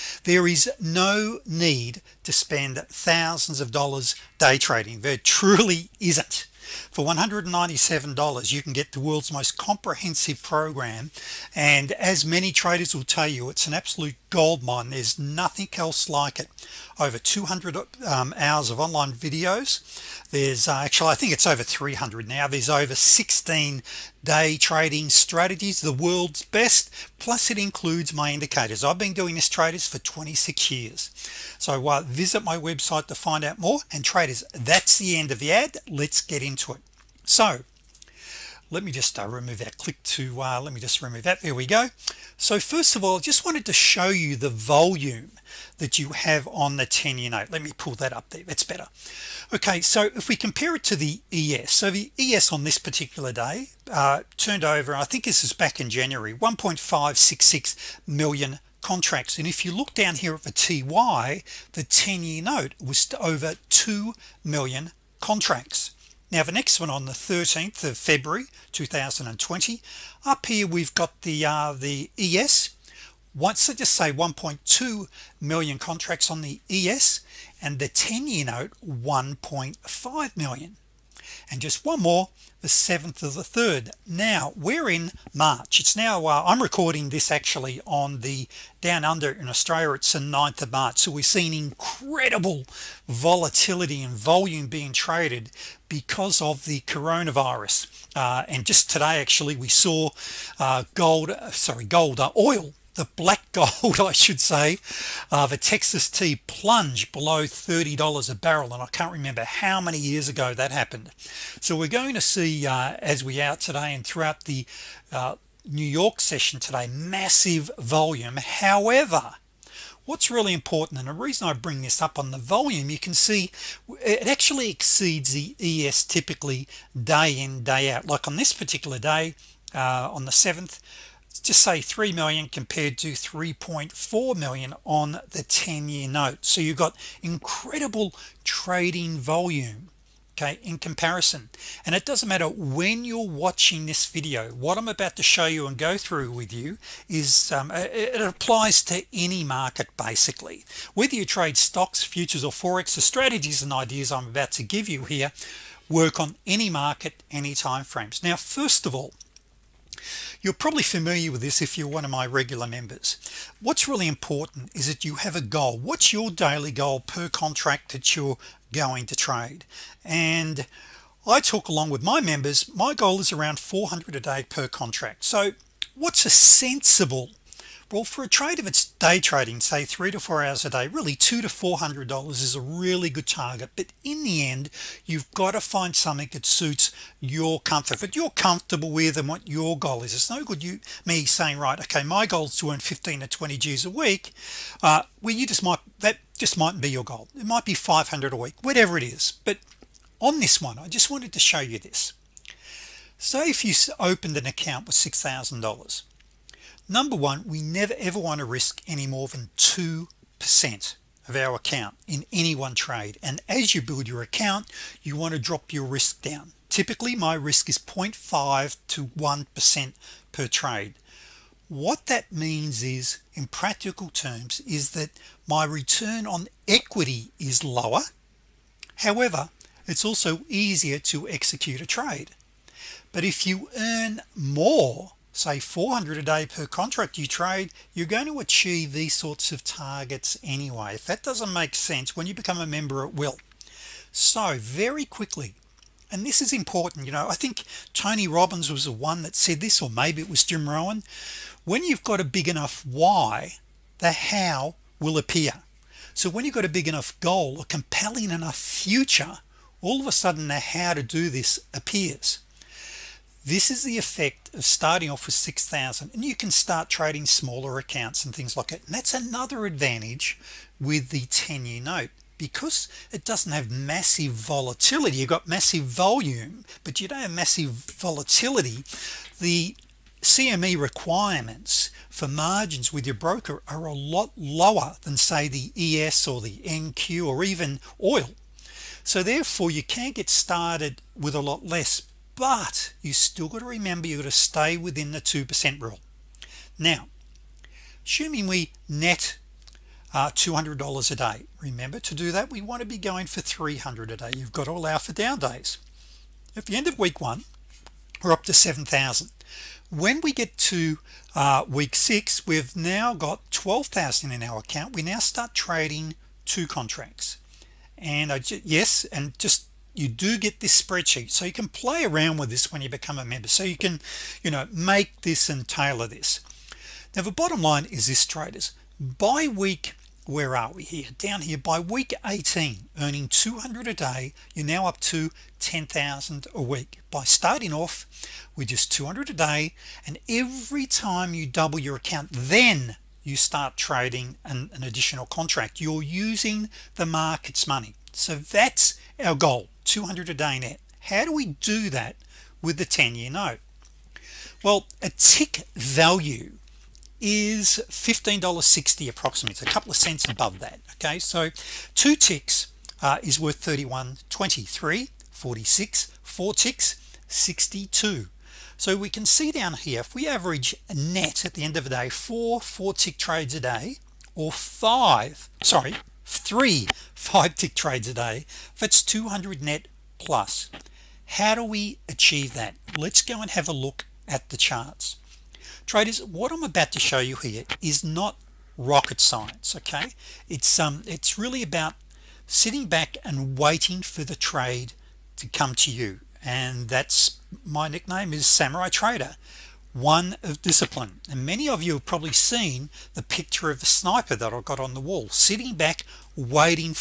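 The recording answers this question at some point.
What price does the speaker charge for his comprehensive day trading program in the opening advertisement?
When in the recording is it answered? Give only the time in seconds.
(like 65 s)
7 s.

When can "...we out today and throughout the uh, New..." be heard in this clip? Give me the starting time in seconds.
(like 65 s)
113 s.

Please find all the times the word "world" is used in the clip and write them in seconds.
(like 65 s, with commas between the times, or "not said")
8 s, 25 s.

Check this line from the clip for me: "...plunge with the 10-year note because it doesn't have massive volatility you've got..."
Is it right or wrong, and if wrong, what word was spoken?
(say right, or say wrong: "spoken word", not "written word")
wrong: "advantage", not "plunge".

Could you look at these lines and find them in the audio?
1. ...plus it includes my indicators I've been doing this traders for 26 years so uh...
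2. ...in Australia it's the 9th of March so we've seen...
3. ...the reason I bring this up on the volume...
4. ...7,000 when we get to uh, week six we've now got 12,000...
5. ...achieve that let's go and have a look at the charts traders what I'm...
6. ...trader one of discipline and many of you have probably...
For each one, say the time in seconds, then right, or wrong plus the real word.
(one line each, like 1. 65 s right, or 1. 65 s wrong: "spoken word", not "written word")
1. 27 s right
2. 89 s right
3. 121 s right
4. 308 s right
5. 382 s right
6. 398 s right.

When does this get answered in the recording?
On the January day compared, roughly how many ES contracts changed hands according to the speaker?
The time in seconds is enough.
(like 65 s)
56 s.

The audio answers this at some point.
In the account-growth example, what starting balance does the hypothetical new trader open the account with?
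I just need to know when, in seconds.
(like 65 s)
204 s.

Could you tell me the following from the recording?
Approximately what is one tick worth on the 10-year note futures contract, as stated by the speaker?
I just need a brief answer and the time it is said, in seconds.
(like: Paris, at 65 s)
$15.60, at 357 s.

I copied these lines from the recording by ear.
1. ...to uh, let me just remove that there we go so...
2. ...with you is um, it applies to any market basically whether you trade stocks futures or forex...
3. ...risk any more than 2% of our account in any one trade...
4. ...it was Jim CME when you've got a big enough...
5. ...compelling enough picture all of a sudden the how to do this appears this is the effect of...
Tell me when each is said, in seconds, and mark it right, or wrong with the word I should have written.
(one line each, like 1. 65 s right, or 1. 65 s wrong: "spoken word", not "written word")
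1. 40 s right
2. 146 s right
3. 208 s right
4. 250 s wrong: "Rohn", not "CME"
5. 257 s wrong: "future", not "picture".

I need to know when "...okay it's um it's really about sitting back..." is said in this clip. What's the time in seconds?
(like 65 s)
389 s.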